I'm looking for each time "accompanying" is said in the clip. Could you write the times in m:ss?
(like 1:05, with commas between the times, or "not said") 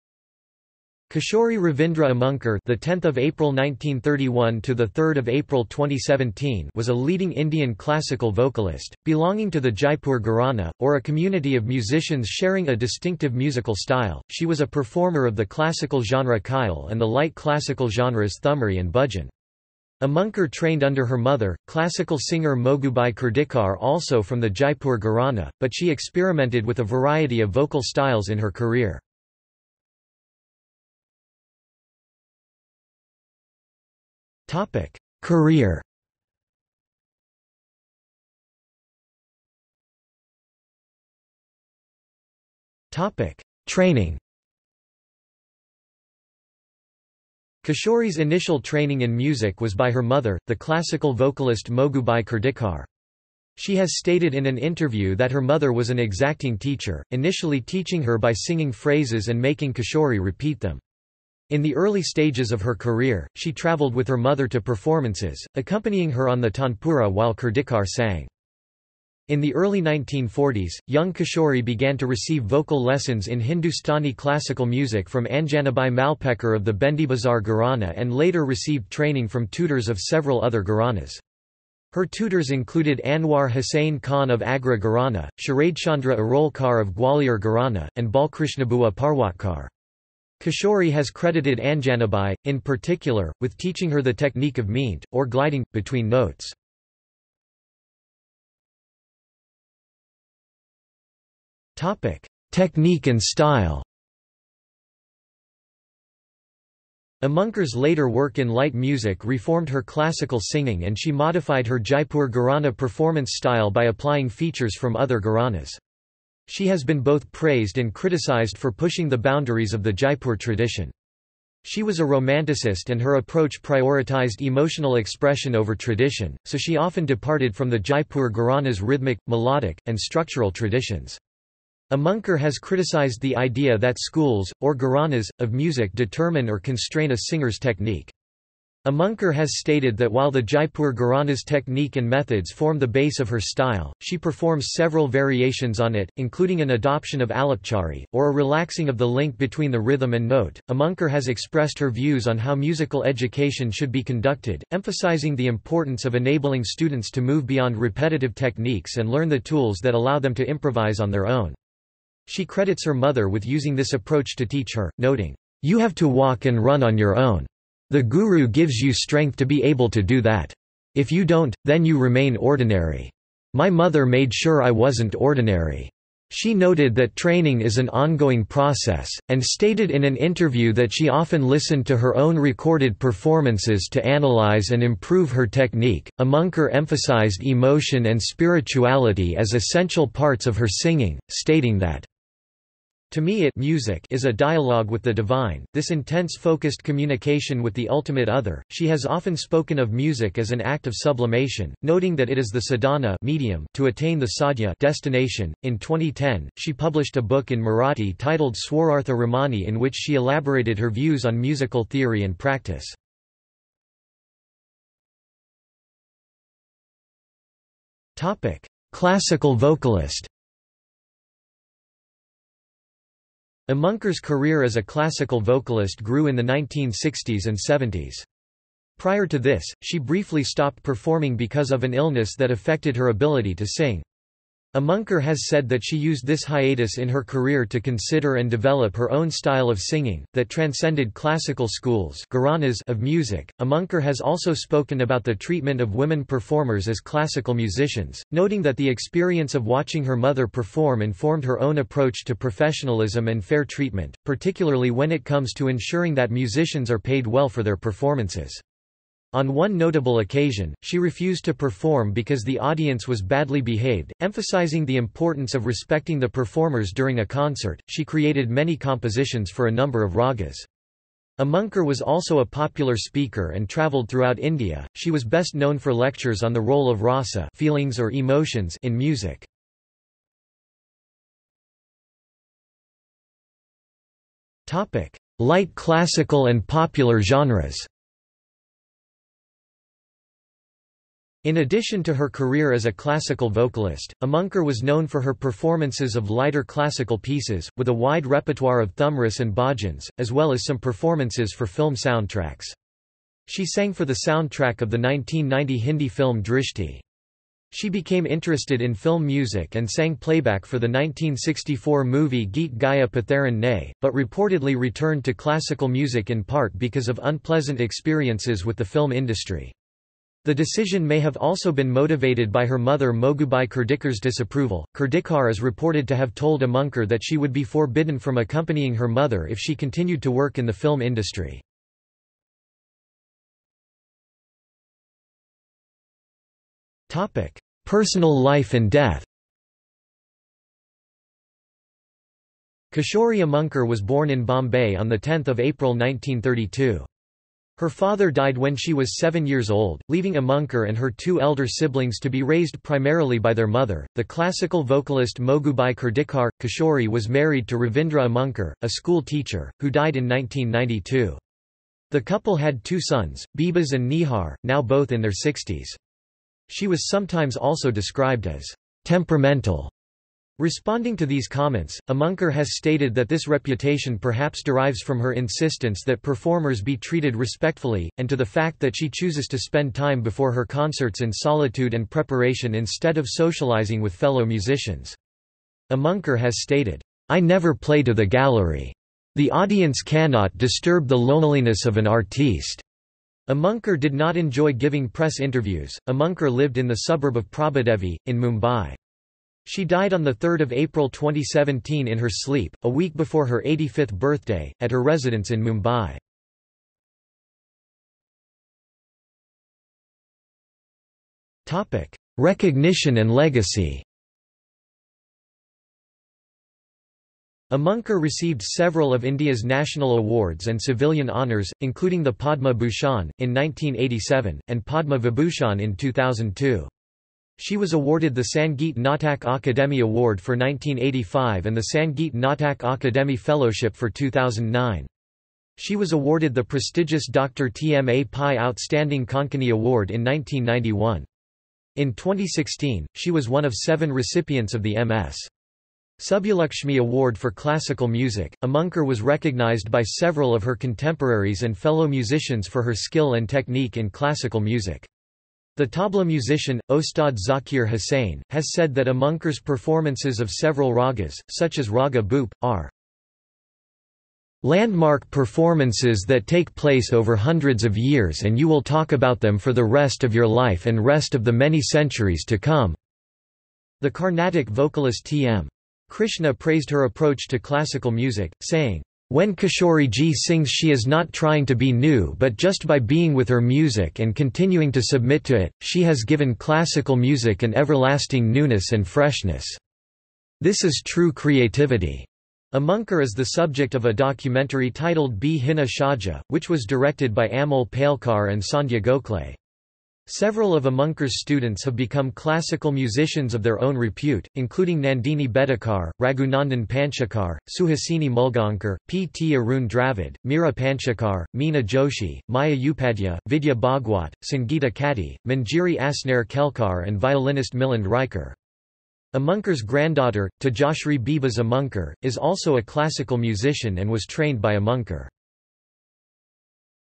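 1:05, 5:28.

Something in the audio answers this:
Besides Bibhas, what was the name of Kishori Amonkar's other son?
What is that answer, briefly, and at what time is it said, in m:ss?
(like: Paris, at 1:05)
Nihar, at 6:04.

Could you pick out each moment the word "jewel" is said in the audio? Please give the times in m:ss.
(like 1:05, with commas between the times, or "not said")
not said.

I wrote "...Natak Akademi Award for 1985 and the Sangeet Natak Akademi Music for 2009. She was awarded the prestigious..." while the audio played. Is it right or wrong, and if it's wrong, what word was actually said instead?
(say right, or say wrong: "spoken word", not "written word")
wrong: "Fellowship", not "Music".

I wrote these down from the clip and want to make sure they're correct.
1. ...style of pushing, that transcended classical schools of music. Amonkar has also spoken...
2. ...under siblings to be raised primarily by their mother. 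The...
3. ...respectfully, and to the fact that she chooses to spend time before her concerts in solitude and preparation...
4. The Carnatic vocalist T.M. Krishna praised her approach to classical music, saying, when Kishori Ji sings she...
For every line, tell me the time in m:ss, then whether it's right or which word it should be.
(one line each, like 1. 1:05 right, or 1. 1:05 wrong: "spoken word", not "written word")
1. 3:59 wrong: "singing", not "pushing"
2. 5:51 wrong: "elder", not "under"
3. 6:17 right
4. 7:54 right.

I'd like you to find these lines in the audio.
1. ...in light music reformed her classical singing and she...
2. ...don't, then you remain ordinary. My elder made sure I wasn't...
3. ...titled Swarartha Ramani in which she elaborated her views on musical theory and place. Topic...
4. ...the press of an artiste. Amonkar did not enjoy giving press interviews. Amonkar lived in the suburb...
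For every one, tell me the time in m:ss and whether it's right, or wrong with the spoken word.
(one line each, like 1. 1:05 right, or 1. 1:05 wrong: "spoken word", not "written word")
1. 1:48 right
2. 2:51 wrong: "mother", not "elder"
3. 3:28 wrong: "practice", not "place"
4. 6:31 wrong: "loneliness", not "press".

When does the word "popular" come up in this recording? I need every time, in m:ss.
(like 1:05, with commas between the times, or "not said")
4:32, 4:46.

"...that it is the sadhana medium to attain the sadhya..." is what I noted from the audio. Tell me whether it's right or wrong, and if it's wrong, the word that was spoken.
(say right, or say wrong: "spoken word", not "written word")
right.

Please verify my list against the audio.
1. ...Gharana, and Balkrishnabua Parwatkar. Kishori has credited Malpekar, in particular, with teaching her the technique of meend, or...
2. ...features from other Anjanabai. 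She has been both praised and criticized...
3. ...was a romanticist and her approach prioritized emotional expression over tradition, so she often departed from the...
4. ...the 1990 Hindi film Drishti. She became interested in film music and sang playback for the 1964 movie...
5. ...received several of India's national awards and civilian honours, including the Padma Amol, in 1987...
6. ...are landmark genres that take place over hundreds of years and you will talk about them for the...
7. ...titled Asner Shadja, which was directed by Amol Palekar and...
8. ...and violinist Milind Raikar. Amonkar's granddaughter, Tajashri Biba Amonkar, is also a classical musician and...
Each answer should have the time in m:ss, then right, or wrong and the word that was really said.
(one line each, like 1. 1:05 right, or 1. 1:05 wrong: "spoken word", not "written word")
1. 1:27 wrong: "Anjanabai", not "Malpekar"
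2. 1:54 wrong: "Gharanas", not "Anjanabai"
3. 2:01 right
4. 5:04 right
5. 6:58 wrong: "Bhushan", not "Amol"
6. 7:42 wrong: "performances", not "genres"
7. 8:14 wrong: "Bhinna", not "Asner"
8. 8:37 right.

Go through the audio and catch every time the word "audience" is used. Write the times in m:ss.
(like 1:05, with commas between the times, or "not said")
4:22, 6:29.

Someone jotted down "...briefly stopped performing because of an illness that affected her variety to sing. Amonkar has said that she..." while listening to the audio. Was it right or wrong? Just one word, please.
wrong.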